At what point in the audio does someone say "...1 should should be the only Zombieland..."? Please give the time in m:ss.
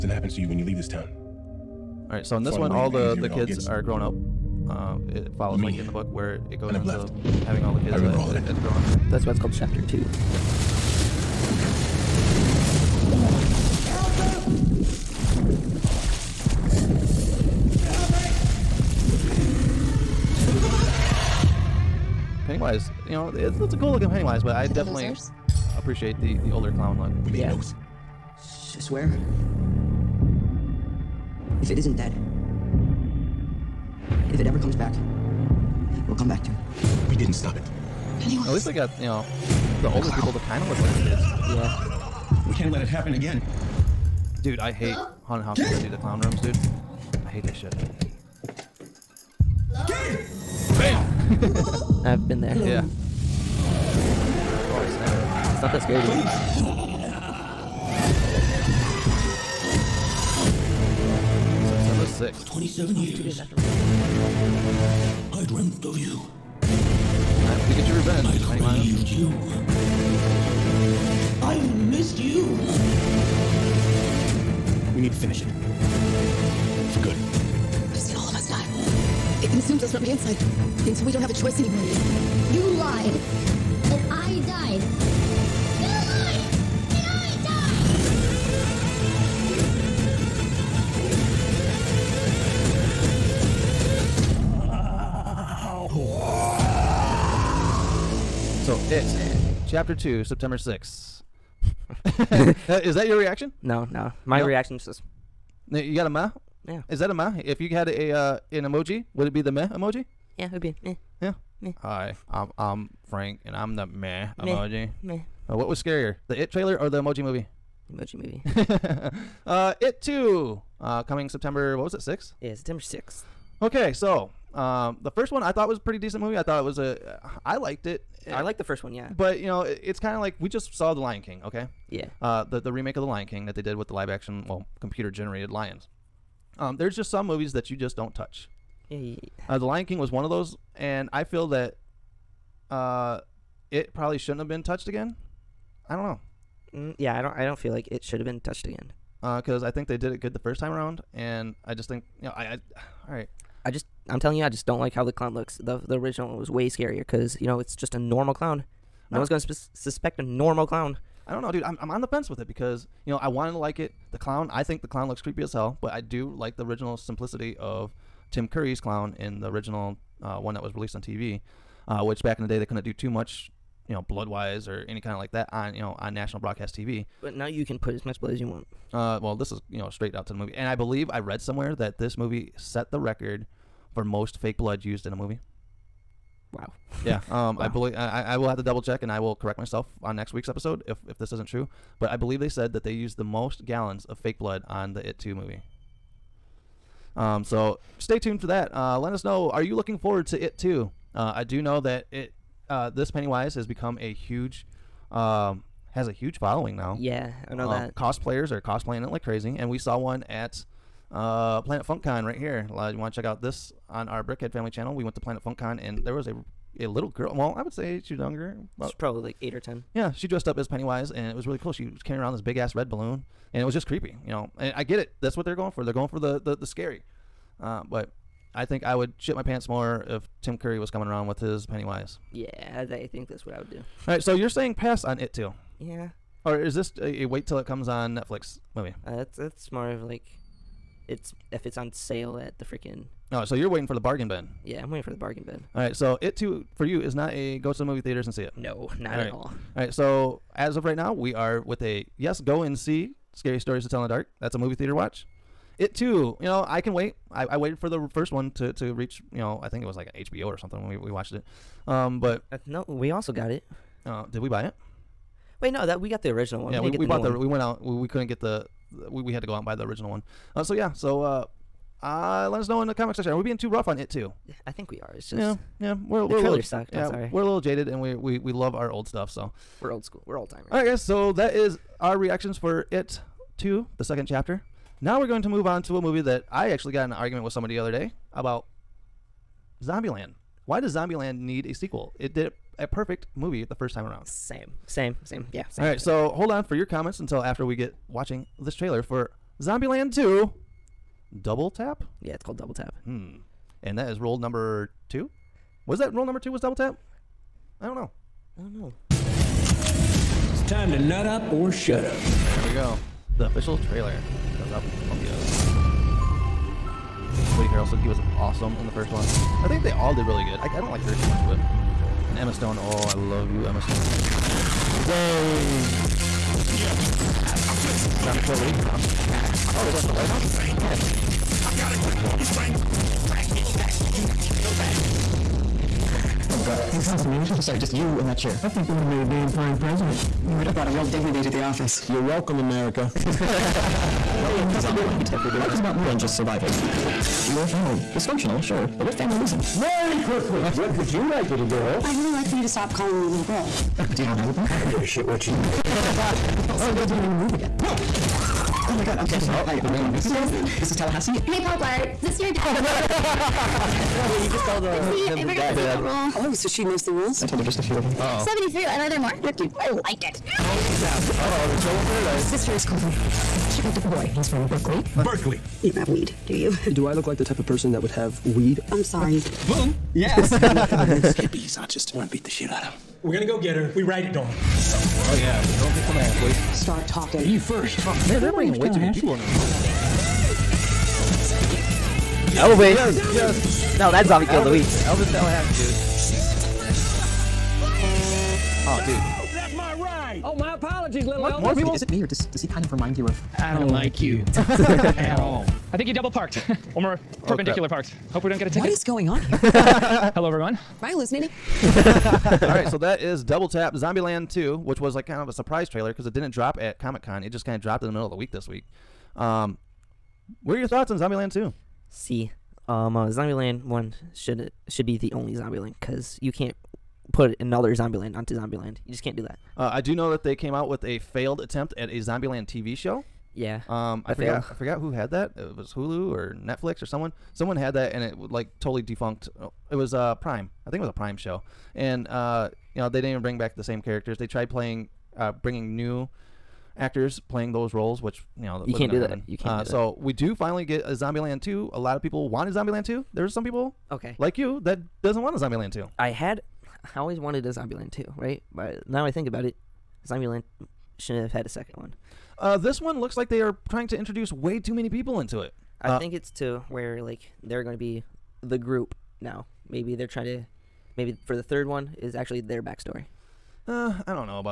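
7:03.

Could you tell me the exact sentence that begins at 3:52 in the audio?
Yeah, I think that's what I would do.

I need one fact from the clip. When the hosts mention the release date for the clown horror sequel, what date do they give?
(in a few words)
September 6th.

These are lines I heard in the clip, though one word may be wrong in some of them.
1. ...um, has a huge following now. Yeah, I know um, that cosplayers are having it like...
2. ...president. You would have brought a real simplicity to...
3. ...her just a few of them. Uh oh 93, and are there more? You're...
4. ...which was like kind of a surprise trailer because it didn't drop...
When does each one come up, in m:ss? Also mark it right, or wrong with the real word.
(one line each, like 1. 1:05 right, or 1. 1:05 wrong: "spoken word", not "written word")
1. 3:25 wrong: "cosplaying", not "having"
2. 5:39 wrong: "dignity", not "simplicity"
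3. 6:07 wrong: "73", not "93"
4. 6:54 right.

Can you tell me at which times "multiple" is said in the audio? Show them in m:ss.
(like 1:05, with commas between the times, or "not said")
not said.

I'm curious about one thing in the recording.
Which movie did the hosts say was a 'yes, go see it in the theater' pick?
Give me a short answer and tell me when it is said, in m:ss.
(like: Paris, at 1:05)
Scary Stories to Tell in the Dark, at 4:13.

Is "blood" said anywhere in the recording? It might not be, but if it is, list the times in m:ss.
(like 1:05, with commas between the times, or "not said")
2:54, 2:58, 3:04, 3:14.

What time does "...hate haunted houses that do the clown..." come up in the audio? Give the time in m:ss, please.
0:44.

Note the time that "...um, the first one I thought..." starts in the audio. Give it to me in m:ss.
2:04.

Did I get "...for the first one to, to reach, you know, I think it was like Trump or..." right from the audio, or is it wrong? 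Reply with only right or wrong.
wrong.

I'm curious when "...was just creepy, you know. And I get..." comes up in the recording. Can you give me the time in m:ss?
3:43.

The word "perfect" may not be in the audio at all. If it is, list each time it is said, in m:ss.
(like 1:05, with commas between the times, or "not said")
4:52.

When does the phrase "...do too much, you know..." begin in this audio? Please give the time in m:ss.
2:52.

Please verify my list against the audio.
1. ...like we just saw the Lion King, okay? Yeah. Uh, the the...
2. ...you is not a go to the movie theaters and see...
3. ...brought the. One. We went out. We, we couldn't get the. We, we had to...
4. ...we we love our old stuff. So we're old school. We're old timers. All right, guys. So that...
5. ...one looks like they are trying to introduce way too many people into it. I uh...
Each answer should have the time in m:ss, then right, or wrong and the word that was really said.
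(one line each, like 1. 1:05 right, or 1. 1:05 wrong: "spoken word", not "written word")
1. 2:10 right
2. 4:06 right
3. 4:27 wrong: "bought", not "brought"
4. 4:38 right
5. 7:42 right.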